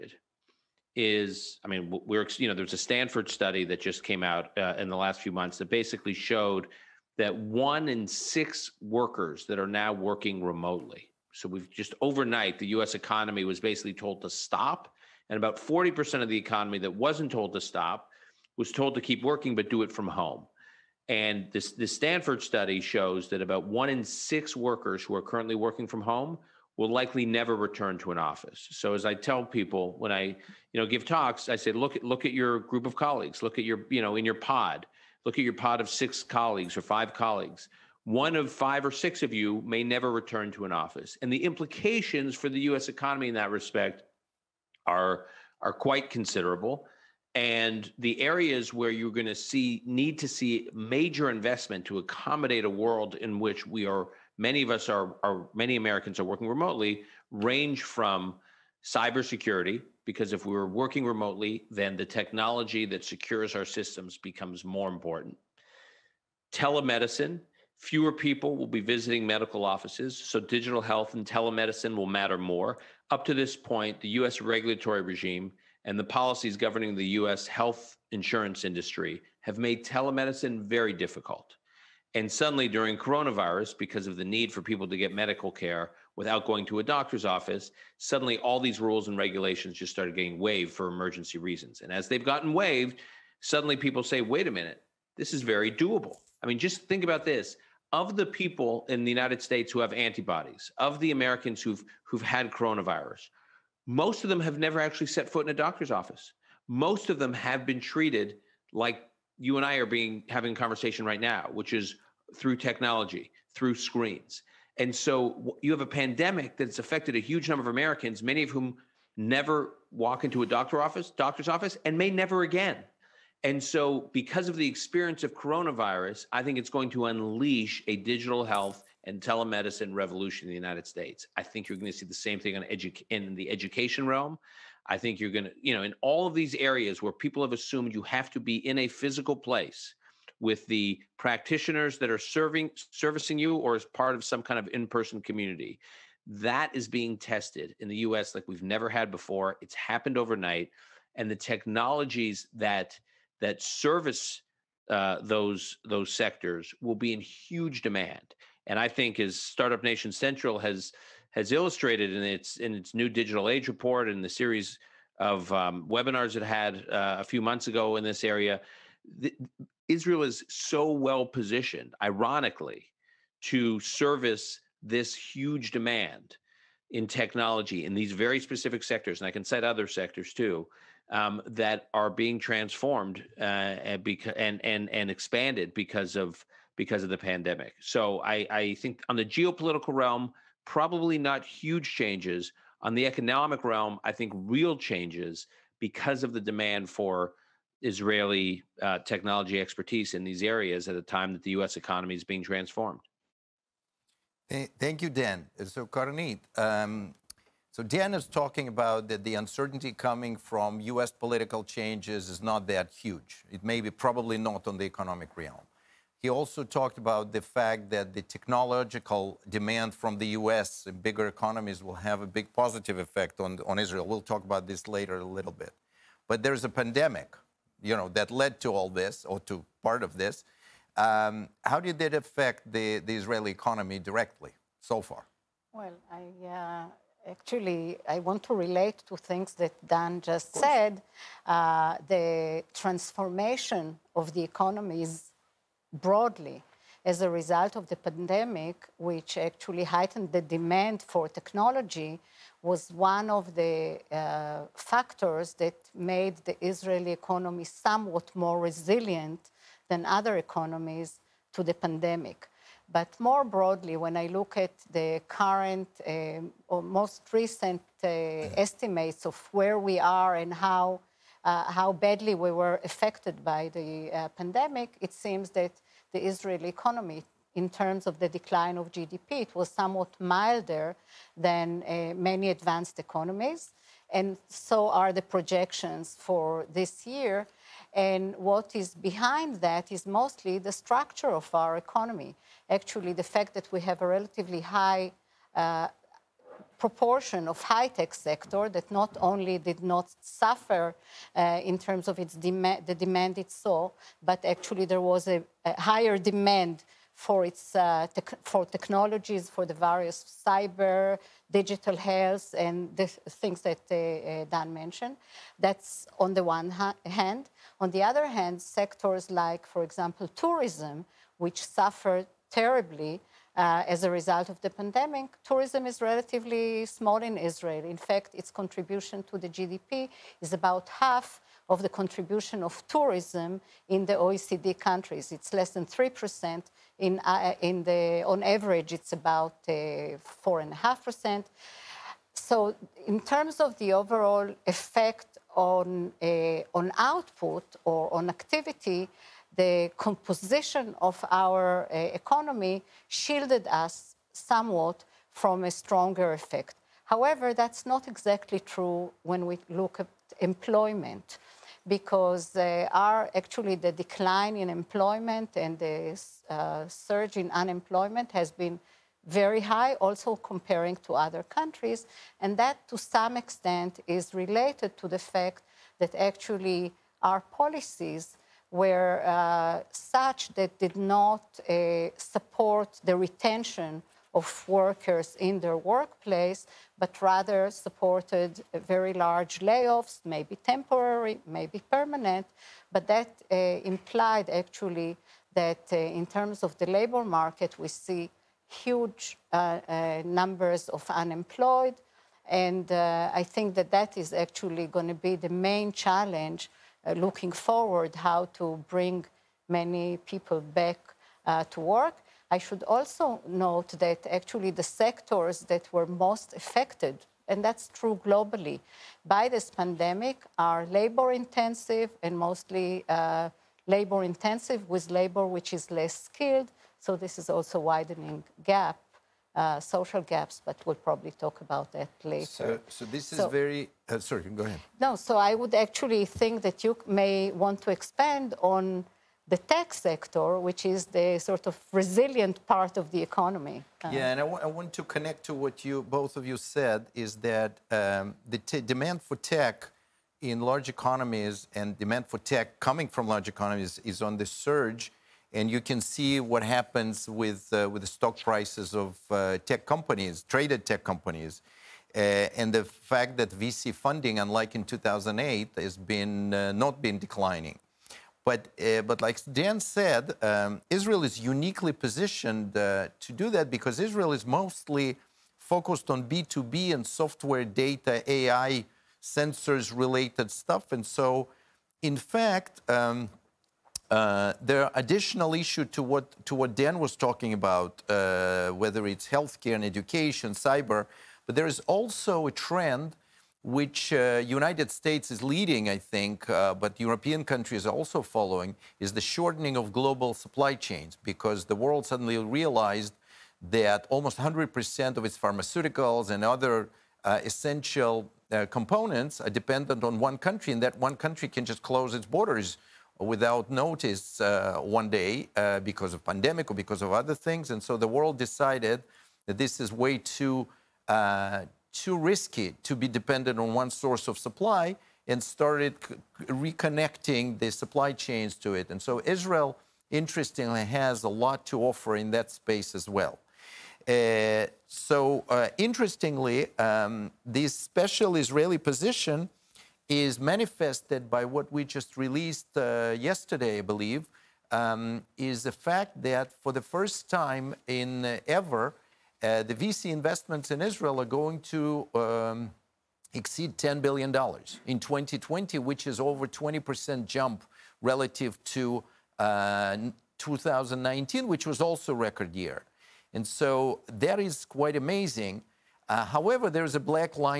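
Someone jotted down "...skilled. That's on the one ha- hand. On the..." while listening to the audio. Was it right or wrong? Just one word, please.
wrong.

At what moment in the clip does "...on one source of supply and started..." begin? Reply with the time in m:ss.
8:43.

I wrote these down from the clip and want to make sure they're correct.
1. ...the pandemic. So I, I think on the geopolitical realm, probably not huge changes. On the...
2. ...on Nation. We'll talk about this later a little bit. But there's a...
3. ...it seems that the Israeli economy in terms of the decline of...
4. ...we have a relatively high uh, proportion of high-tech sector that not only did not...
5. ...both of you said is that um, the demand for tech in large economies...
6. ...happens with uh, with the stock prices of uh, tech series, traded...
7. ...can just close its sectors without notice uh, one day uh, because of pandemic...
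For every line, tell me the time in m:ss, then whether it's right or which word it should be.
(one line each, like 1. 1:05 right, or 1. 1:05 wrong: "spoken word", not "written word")
1. 3:07 right
2. 3:43 wrong: "Israel", not "Nation"
3. 4:35 right
4. 4:53 right
5. 7:26 right
6. 7:36 wrong: "companies", not "series"
7. 8:31 wrong: "borders", not "sectors".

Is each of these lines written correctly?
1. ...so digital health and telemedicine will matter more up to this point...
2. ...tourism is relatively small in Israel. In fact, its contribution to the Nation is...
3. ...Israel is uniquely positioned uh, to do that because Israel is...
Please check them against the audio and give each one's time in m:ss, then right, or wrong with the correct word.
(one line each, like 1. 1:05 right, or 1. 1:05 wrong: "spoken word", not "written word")
1. 1:10 right
2. 5:25 wrong: "GDP", not "Nation"
3. 7:50 right.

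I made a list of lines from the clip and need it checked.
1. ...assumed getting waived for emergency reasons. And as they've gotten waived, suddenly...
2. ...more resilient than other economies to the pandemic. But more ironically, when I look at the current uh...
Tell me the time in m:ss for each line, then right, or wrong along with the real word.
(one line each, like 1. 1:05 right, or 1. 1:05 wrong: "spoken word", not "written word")
1. 1:29 wrong: "started", not "assumed"
2. 4:18 wrong: "broadly", not "ironically".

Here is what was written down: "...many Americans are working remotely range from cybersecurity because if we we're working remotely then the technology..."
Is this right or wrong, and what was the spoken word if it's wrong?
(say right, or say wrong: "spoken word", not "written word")
right.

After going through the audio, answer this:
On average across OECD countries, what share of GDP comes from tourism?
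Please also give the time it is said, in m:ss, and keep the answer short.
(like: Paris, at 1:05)
4.5%, at 5:39.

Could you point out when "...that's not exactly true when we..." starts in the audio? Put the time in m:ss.
5:57.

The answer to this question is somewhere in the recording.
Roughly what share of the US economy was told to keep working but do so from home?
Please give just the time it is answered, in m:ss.
0:15.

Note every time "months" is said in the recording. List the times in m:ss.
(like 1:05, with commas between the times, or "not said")
0:05, 2:47.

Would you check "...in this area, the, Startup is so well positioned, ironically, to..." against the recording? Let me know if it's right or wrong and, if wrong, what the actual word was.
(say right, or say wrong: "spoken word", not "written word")
wrong: "Israel", not "Startup".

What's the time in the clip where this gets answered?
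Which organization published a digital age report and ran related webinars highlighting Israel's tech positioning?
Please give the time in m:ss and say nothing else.
2:39.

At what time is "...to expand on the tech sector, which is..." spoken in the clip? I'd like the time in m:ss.
7:17.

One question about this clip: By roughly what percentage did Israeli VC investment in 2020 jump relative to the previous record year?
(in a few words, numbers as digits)
20%.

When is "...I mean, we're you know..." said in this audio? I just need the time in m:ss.
0:01.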